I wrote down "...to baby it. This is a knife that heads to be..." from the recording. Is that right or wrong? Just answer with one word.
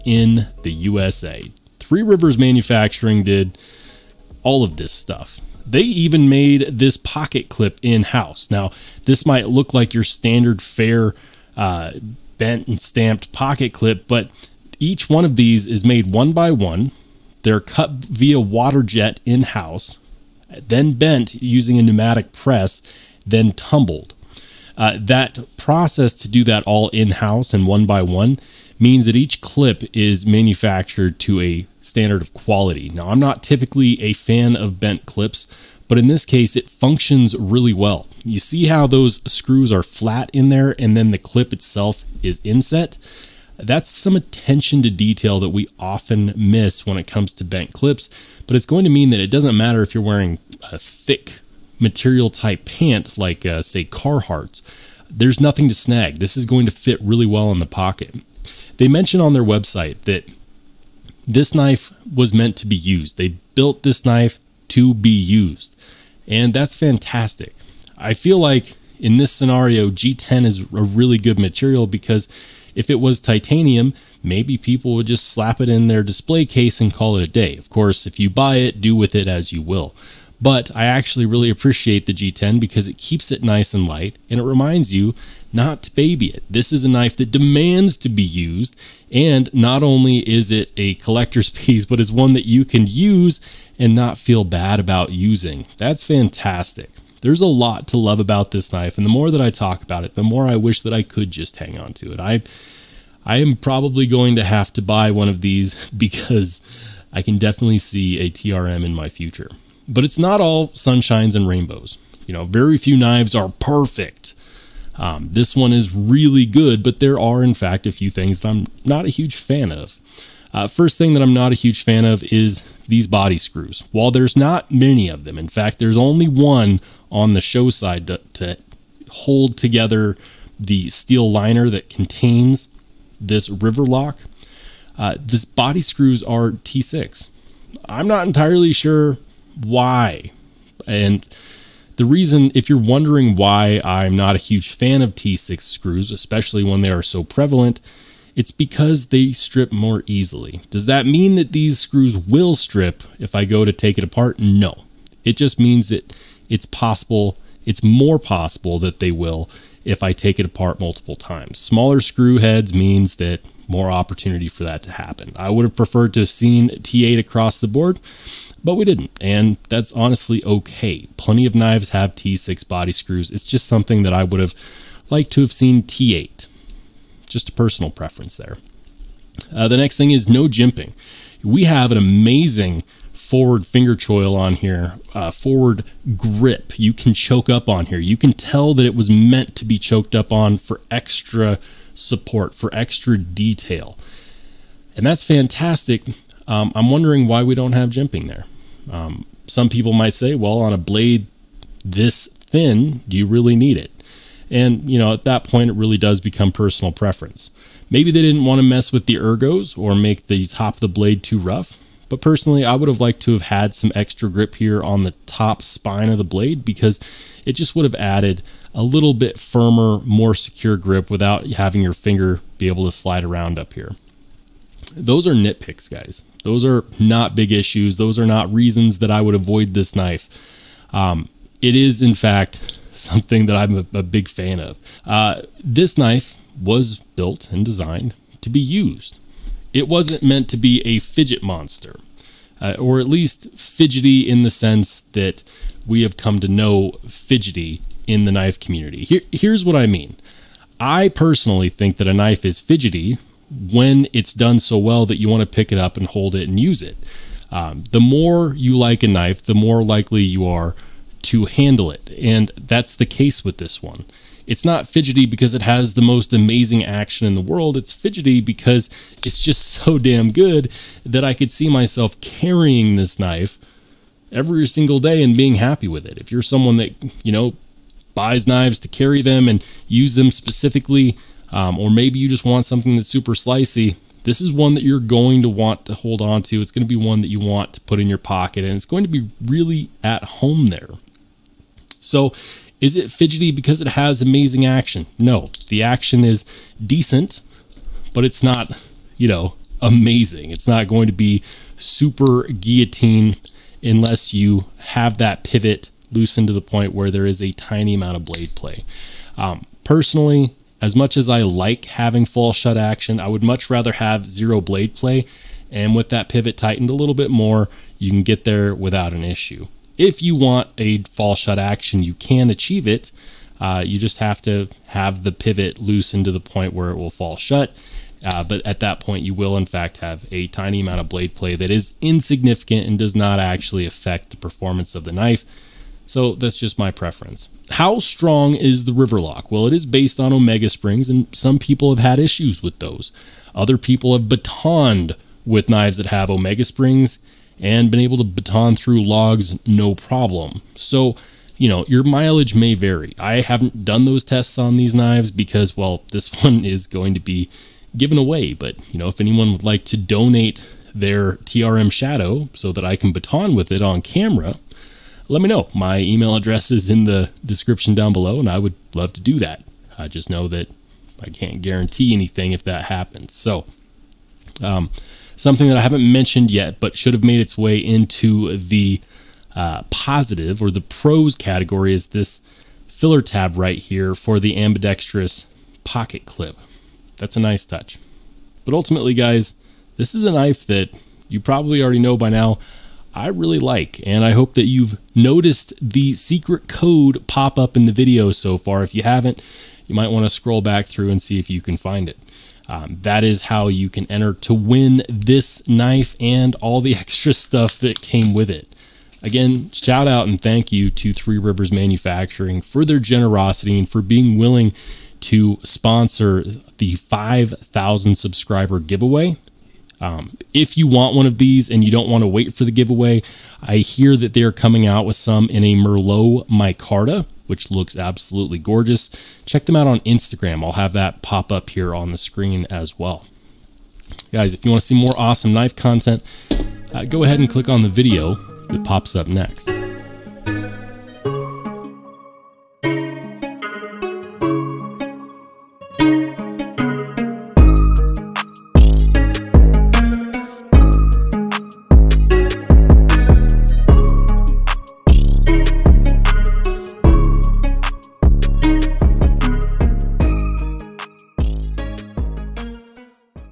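wrong.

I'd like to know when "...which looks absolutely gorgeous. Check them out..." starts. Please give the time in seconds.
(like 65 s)
427 s.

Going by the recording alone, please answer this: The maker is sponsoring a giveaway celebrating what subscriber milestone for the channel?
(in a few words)
5,000.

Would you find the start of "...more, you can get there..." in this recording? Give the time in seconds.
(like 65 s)
317 s.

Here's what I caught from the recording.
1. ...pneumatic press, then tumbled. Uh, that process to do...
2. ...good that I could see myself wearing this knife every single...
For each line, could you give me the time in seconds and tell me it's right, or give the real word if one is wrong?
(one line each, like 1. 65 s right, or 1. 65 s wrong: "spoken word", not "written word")
1. 21 s right
2. 270 s wrong: "carrying", not "wearing".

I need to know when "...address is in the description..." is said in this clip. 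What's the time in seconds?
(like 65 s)
366 s.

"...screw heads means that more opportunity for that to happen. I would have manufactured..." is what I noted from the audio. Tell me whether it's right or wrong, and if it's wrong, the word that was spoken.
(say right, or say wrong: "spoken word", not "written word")
wrong: "preferred", not "manufactured".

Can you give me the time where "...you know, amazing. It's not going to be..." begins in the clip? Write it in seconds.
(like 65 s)
299 s.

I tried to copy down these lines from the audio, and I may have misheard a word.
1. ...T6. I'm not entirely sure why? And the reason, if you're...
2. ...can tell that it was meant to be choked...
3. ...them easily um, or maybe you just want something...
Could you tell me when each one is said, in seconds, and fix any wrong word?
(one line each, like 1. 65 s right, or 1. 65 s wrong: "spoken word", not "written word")
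1. 136 s right
2. 188 s right
3. 280 s wrong: "specifically", not "easily".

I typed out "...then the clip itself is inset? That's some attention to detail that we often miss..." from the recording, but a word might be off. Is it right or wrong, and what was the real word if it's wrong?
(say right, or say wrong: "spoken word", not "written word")
right.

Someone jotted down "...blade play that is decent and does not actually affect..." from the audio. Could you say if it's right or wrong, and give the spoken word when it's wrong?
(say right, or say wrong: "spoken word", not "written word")
wrong: "insignificant", not "decent".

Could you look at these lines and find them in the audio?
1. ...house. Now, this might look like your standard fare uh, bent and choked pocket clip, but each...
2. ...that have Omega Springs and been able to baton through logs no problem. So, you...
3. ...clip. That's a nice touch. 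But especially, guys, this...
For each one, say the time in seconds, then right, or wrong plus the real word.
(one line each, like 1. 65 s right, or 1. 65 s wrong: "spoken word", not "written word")
1. 8 s wrong: "stamped", not "choked"
2. 345 s right
3. 386 s wrong: "ultimately", not "especially".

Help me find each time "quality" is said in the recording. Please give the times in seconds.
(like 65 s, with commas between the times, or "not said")
32 s.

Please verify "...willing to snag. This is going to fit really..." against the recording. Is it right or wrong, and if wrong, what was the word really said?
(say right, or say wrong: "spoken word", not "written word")
wrong: "nothing", not "willing".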